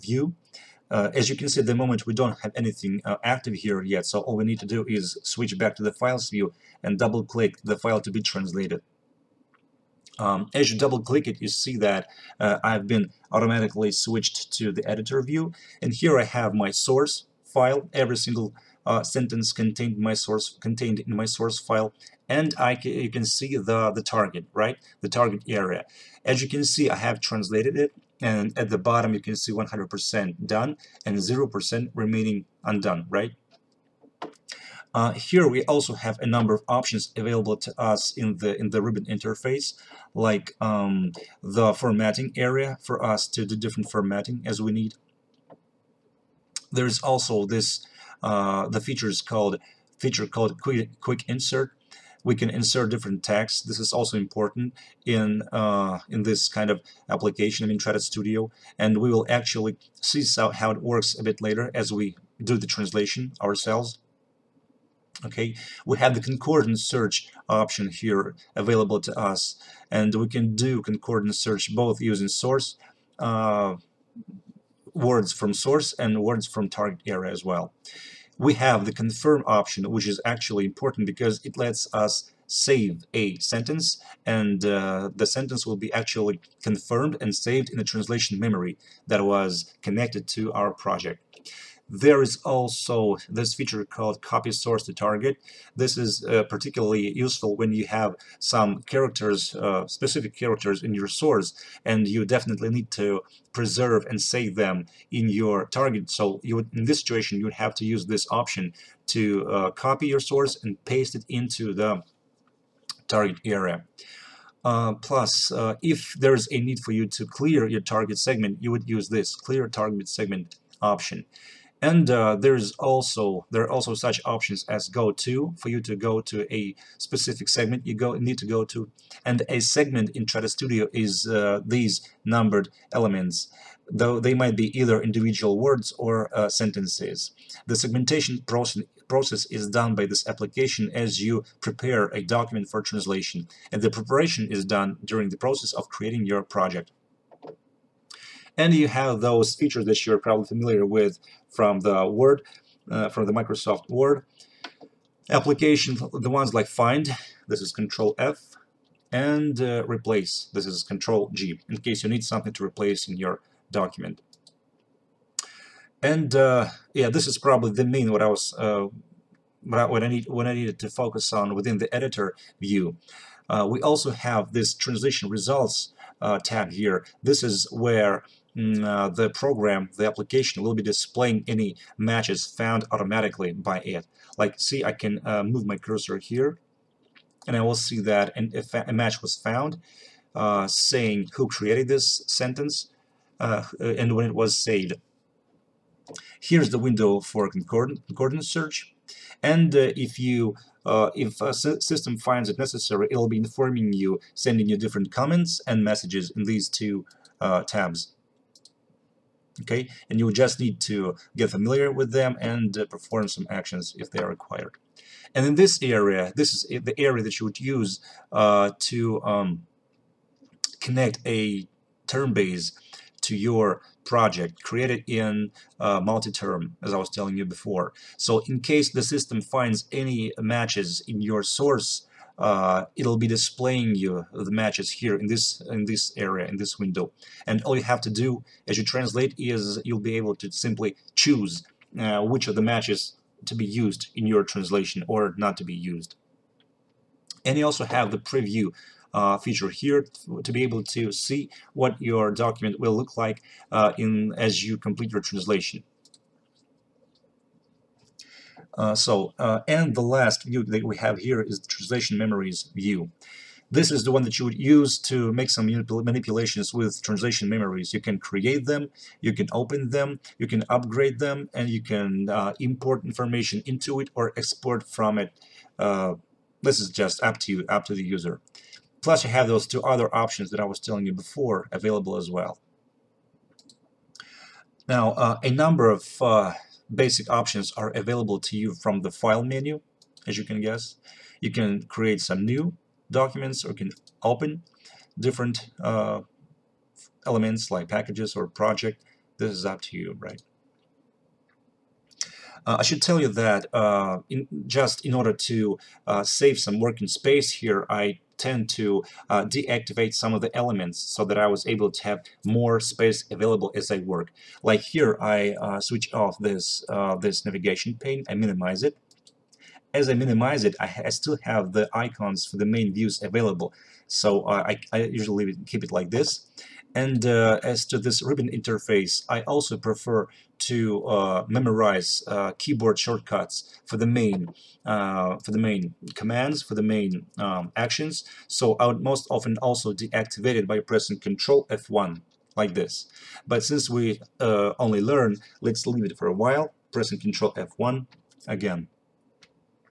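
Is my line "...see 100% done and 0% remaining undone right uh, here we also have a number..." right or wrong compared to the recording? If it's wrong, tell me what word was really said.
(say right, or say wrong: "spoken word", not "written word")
right.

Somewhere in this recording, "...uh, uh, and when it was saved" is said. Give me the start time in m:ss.
3:13.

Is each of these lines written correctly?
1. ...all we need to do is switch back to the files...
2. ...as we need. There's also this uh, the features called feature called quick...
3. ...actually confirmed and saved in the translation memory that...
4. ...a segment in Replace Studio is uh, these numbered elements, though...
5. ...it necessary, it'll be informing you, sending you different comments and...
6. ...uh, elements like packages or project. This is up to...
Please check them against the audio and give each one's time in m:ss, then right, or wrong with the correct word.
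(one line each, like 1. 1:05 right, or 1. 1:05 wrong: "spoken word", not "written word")
1. 0:04 right
2. 0:44 right
3. 1:25 right
4. 2:09 wrong: "Trados", not "Replace"
5. 3:22 right
6. 4:55 right.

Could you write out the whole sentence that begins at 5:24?
So uh, I, I usually keep it like this.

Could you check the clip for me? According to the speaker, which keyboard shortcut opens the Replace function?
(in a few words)
Control G.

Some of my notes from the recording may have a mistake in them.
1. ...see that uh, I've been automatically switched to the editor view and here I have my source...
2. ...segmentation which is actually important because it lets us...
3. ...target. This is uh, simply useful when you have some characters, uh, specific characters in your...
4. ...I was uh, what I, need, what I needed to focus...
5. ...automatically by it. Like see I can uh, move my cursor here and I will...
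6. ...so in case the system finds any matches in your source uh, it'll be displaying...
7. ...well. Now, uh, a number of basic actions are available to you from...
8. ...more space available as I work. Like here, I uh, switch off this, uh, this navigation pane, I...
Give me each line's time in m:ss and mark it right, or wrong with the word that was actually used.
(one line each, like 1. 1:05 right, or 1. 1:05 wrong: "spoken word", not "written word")
1. 0:11 right
2. 1:19 wrong: "option", not "segmentation"
3. 1:34 wrong: "particularly", not "simply"
4. 2:48 right
5. 3:02 right
6. 3:48 right
7. 4:42 wrong: "options", not "actions"
8. 5:12 right.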